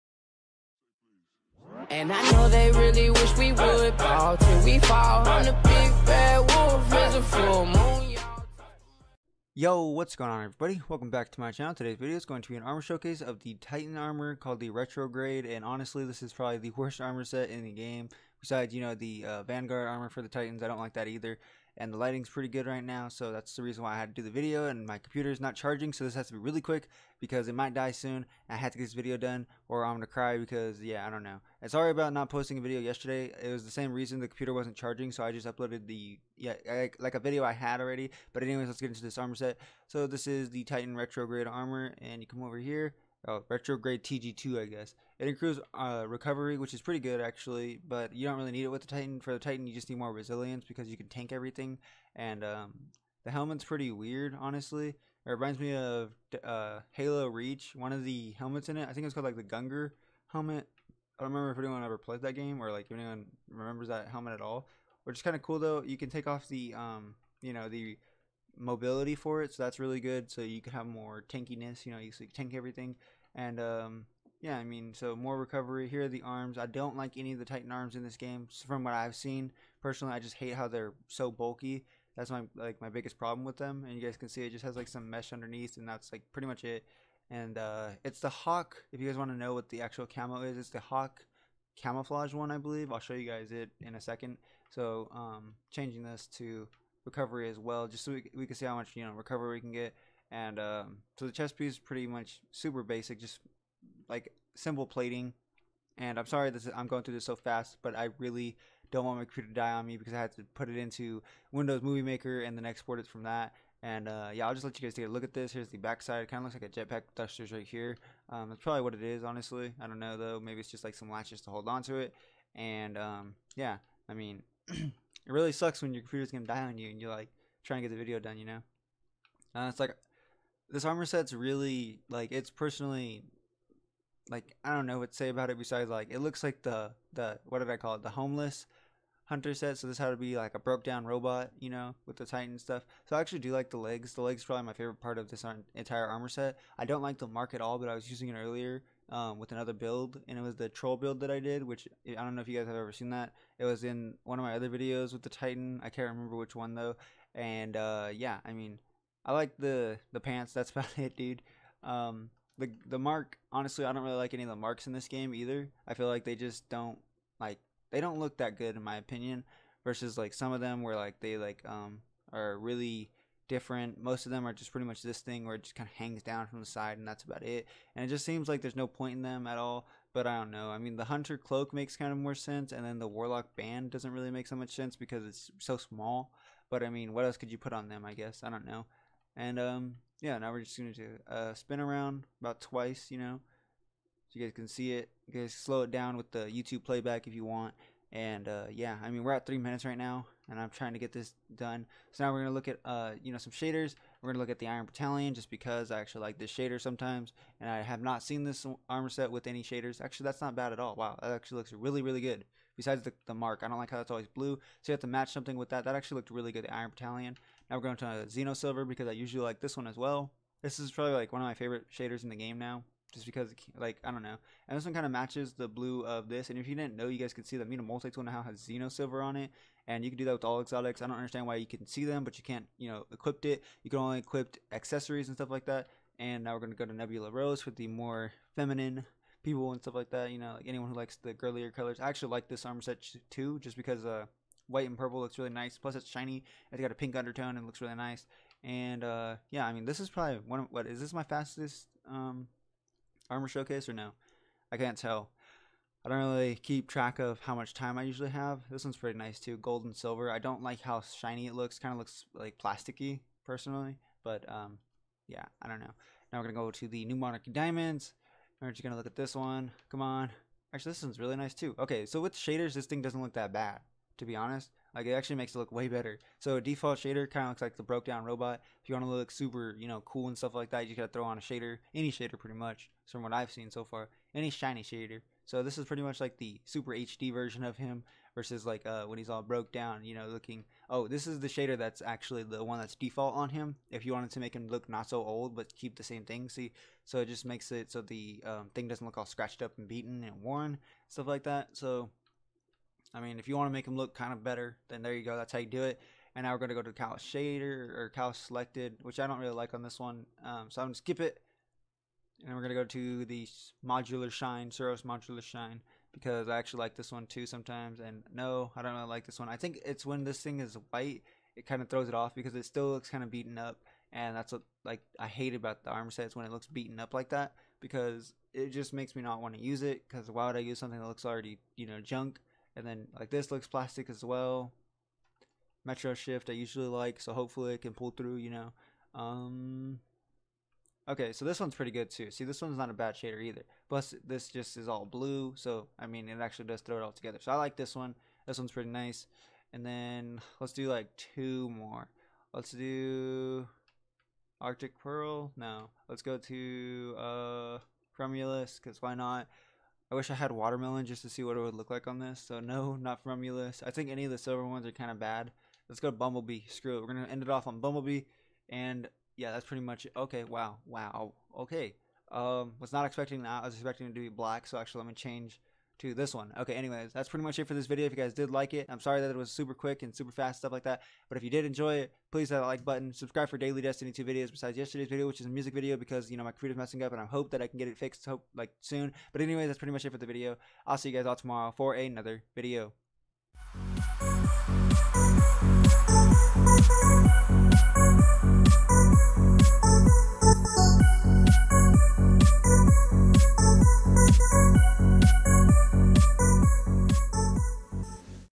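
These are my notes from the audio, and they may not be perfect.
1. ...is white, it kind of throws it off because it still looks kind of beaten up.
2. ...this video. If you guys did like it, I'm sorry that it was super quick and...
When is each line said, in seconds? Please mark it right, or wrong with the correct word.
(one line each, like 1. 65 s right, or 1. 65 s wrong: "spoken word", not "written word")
1. 320 s right
2. 377 s right.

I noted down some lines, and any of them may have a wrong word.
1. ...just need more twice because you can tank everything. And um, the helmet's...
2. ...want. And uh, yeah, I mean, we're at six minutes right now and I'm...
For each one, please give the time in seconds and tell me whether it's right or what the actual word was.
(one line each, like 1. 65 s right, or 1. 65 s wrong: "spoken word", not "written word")
1. 49 s wrong: "resilience", not "twice"
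2. 197 s wrong: "three", not "six".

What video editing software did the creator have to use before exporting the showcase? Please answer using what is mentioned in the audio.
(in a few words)
Windows Movie Maker.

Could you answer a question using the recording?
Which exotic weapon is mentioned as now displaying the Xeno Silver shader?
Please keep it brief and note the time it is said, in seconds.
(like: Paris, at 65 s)
Mida Multi-Tool, at 227 s.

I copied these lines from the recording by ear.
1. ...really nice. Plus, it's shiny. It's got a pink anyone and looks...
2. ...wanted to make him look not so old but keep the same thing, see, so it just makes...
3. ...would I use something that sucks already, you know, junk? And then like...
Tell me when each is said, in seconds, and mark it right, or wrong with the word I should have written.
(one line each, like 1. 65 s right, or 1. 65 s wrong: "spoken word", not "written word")
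1. 245 s wrong: "undertone", not "anyone"
2. 294 s right
3. 330 s wrong: "looks", not "sucks".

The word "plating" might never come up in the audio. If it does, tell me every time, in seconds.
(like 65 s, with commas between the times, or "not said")
104 s.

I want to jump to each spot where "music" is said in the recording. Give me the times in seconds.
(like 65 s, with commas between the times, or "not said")
385 s.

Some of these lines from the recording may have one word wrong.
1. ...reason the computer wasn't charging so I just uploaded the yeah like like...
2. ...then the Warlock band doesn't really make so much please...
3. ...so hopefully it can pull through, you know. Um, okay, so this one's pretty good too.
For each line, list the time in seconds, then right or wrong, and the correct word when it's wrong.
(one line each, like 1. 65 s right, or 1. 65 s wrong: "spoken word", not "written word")
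1. 33 s right
2. 182 s wrong: "sense", not "please"
3. 337 s right.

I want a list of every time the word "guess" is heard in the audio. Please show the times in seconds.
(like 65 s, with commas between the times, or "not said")
44 s, 188 s.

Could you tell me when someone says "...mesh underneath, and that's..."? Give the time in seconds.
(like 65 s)
85 s.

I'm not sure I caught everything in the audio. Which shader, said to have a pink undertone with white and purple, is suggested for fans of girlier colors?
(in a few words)
Nebula Rose.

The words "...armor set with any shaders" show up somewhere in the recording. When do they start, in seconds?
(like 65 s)
208 s.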